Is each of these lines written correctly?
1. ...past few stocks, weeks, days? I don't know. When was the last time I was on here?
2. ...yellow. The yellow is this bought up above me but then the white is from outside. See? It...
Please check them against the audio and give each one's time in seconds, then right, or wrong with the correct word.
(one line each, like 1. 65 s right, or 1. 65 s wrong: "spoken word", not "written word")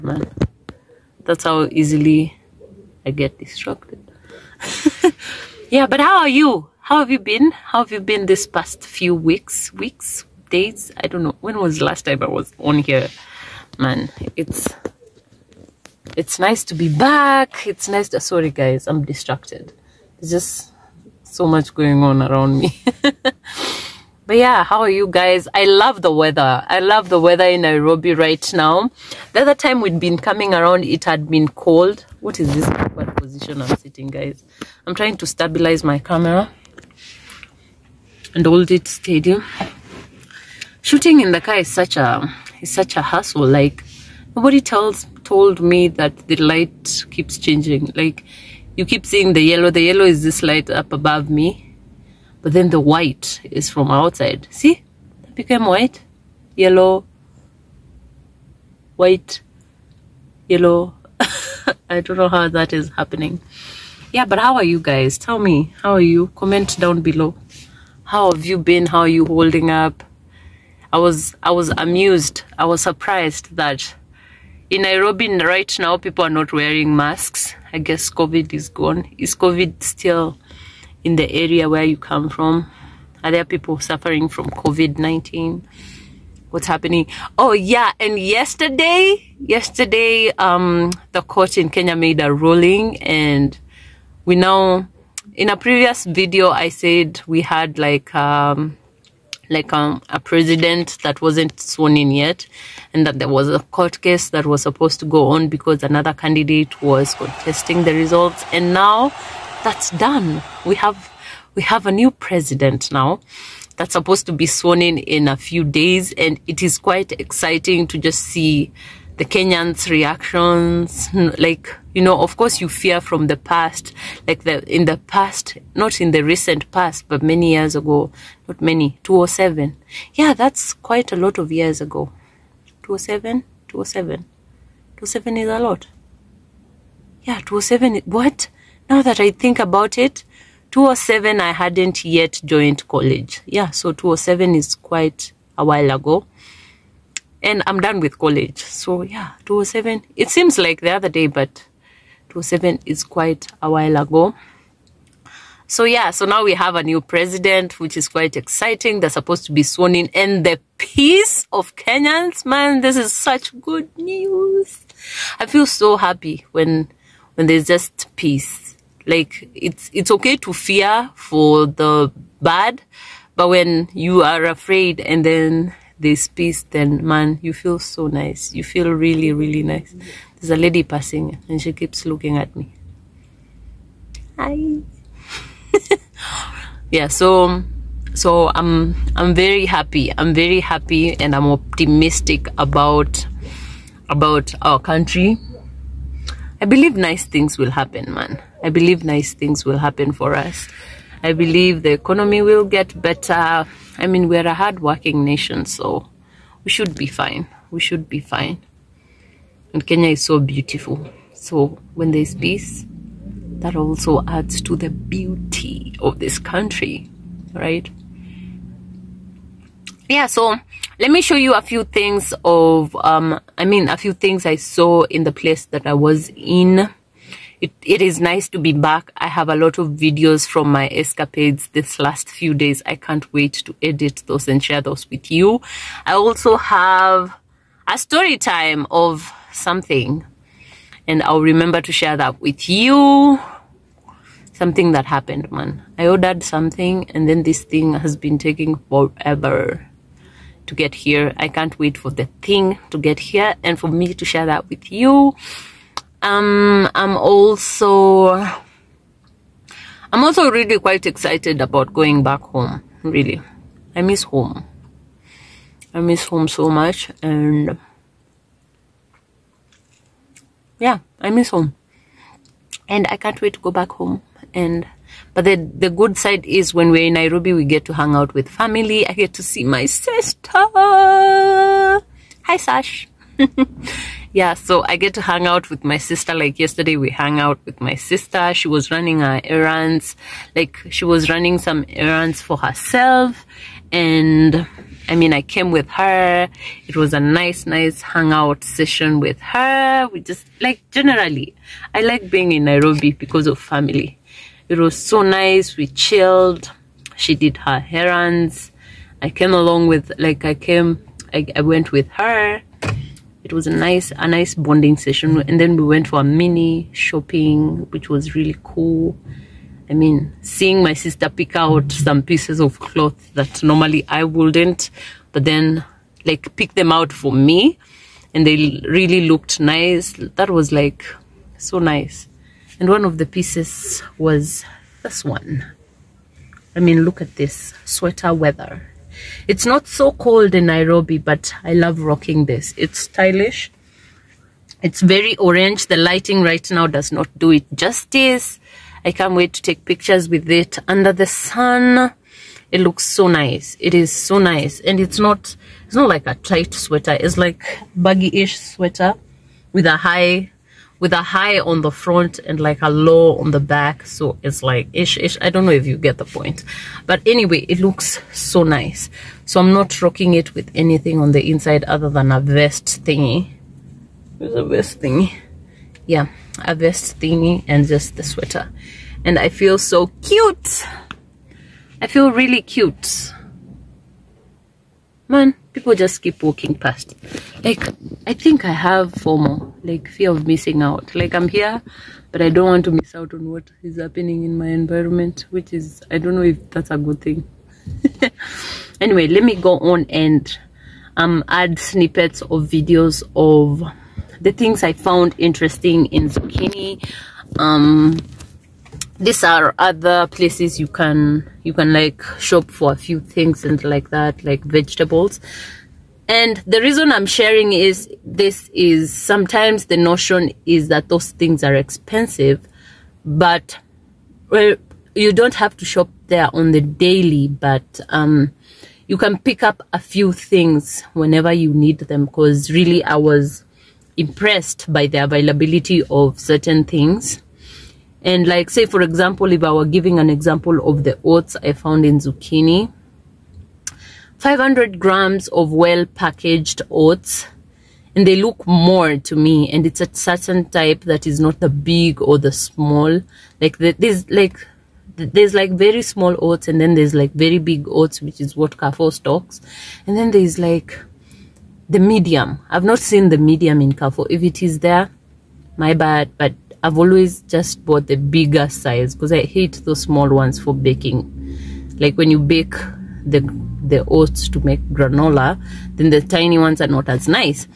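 1. 8 s wrong: "weeks", not "stocks"
2. 49 s wrong: "light", not "bought".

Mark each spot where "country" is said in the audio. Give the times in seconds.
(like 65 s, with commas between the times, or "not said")
194 s, 216 s.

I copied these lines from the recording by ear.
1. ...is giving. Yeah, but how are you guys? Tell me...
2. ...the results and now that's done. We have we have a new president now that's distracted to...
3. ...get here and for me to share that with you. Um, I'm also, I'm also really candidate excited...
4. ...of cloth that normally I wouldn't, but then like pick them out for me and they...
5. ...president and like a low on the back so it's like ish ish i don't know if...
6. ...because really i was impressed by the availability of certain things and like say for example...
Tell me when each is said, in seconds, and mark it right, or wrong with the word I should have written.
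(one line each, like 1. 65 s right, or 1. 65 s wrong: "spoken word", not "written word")
1. 62 s wrong: "happening", not "giving"
2. 107 s wrong: "supposed", not "distracted"
3. 252 s wrong: "quite", not "candidate"
4. 322 s right
5. 361 s wrong: "front", not "president"
6. 432 s right.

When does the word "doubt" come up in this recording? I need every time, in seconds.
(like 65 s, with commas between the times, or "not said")
not said.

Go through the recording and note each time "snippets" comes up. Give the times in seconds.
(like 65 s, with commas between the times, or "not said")
401 s.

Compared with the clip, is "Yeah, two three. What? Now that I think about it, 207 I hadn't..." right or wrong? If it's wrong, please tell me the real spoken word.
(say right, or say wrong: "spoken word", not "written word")
wrong: "seven", not "three".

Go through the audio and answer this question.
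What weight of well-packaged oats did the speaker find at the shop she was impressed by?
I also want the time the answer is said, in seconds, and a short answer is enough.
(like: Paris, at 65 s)
500 grams, at 444 s.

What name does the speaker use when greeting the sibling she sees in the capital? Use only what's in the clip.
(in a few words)
Sash.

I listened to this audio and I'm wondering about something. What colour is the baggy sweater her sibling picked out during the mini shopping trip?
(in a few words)
orange.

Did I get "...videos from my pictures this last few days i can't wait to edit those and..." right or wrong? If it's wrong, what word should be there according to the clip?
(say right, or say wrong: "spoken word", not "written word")
wrong: "escapades", not "pictures".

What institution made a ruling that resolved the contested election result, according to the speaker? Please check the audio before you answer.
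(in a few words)
the court.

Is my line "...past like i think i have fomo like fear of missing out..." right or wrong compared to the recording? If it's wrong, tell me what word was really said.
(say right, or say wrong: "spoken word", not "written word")
right.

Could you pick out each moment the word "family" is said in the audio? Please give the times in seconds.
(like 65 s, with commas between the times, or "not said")
278 s, 303 s.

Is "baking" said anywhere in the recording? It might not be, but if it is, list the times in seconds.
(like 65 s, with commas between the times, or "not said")
470 s.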